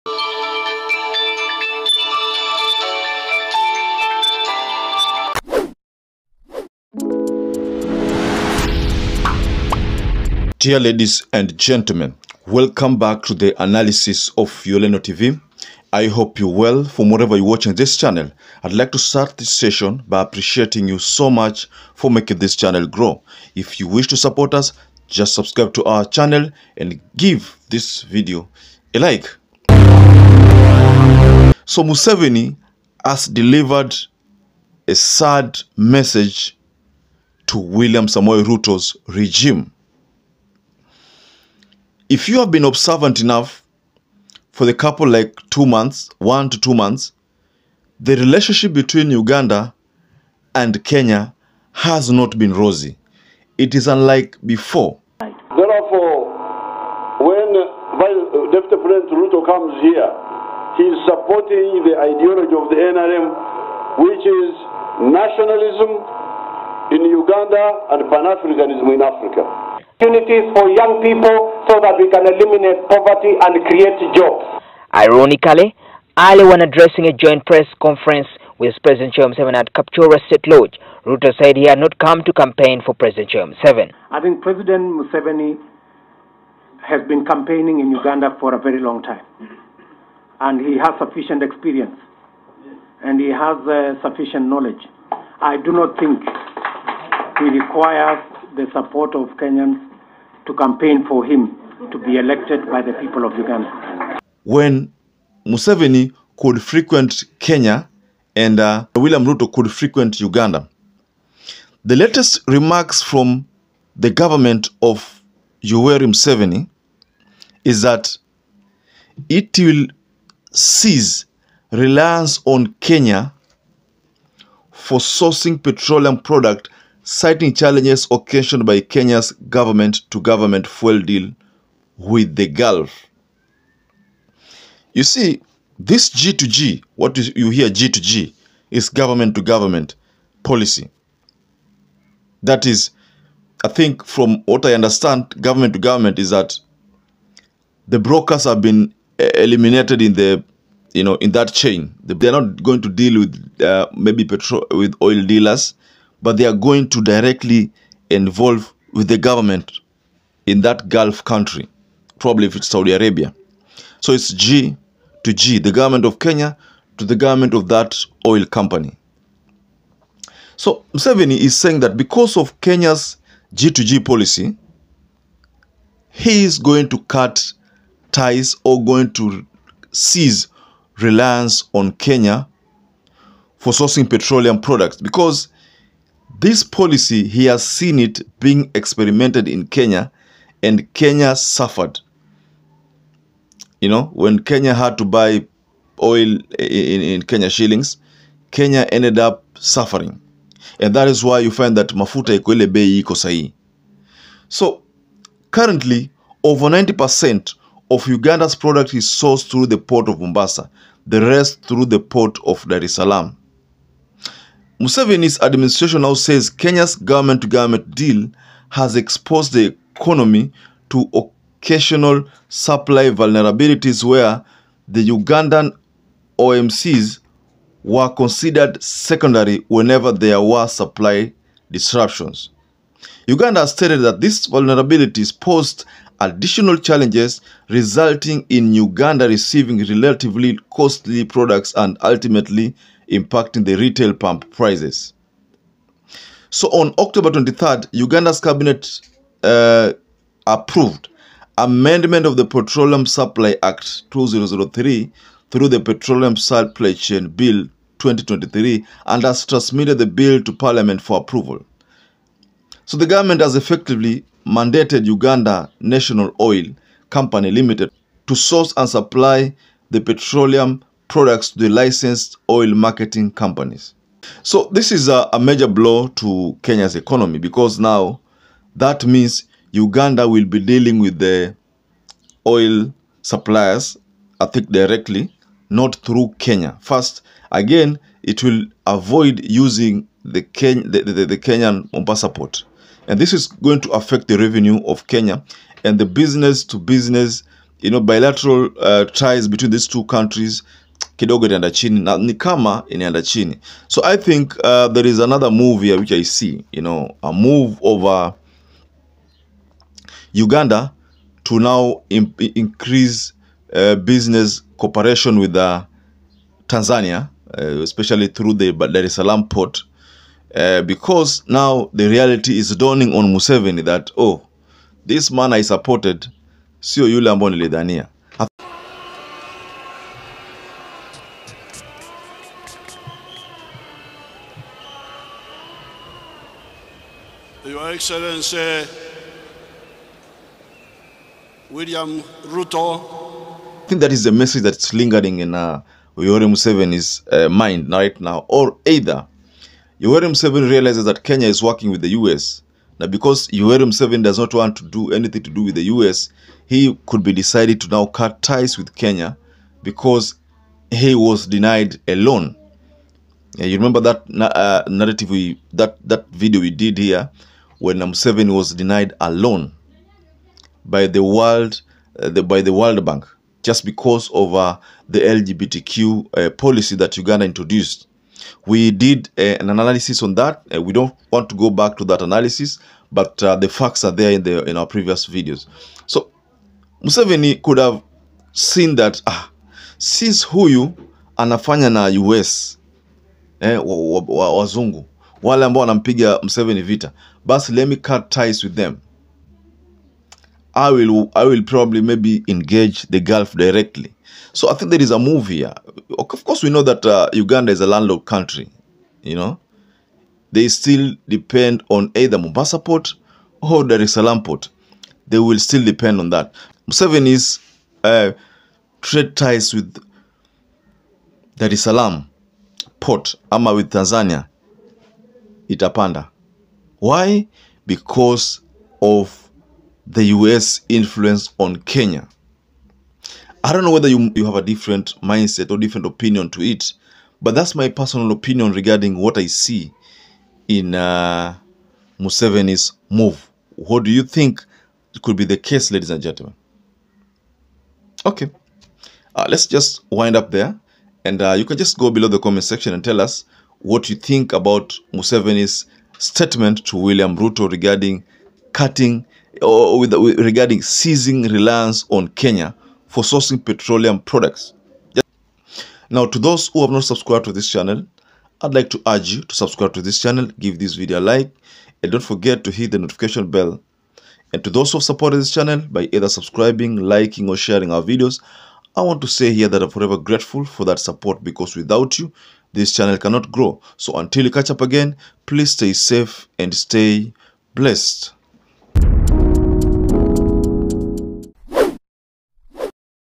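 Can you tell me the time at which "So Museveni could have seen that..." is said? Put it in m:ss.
6:26.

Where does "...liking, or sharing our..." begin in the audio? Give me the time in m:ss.
7:56.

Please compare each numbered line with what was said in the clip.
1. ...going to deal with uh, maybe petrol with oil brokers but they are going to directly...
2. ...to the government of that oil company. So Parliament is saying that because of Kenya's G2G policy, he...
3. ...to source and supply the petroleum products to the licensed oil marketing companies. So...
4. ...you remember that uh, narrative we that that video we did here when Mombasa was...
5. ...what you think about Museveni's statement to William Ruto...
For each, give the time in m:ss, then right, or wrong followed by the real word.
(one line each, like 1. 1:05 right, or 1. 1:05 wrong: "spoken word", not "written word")
1. 2:32 wrong: "dealers", not "brokers"
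2. 2:46 wrong: "Museveni", not "Parliament"
3. 4:28 right
4. 6:03 wrong: "Museveni", not "Mombasa"
5. 7:33 right.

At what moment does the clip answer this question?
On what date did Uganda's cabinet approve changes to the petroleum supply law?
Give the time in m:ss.
4:06.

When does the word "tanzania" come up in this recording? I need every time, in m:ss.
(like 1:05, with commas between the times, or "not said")
5:16, 7:03.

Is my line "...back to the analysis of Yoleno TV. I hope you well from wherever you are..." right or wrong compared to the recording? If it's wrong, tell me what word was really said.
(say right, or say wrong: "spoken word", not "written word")
right.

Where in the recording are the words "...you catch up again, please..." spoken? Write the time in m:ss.
8:04.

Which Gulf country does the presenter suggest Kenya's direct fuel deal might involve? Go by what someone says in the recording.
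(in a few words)
Saudi Arabia.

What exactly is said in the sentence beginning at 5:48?
Or either Yoweri Museveni realizes that Kenya is working with the US.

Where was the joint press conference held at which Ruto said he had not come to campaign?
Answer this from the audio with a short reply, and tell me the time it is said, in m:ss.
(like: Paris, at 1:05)
Kaptura State Lodge, at 1:19.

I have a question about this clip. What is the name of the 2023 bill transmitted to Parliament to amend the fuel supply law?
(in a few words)
Petroleum Supply Chain Bill 2023.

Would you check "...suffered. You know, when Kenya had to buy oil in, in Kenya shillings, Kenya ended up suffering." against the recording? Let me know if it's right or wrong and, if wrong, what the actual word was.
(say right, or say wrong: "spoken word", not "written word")
right.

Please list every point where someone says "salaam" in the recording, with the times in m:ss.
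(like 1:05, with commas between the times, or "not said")
3:32, 5:19, 6:54, 7:01.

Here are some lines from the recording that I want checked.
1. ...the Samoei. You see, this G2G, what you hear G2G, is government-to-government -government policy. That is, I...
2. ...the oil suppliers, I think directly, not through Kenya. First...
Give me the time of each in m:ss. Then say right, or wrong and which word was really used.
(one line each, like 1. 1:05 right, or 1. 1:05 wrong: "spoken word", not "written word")
1. 2:12 wrong: "Gulf", not "Samoei"
2. 4:41 right.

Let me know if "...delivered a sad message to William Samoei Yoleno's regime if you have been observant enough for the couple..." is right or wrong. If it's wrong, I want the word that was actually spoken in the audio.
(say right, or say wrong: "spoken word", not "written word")
wrong: "Ruto", not "Yoleno".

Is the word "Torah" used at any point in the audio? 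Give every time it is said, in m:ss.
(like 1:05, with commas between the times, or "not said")
not said.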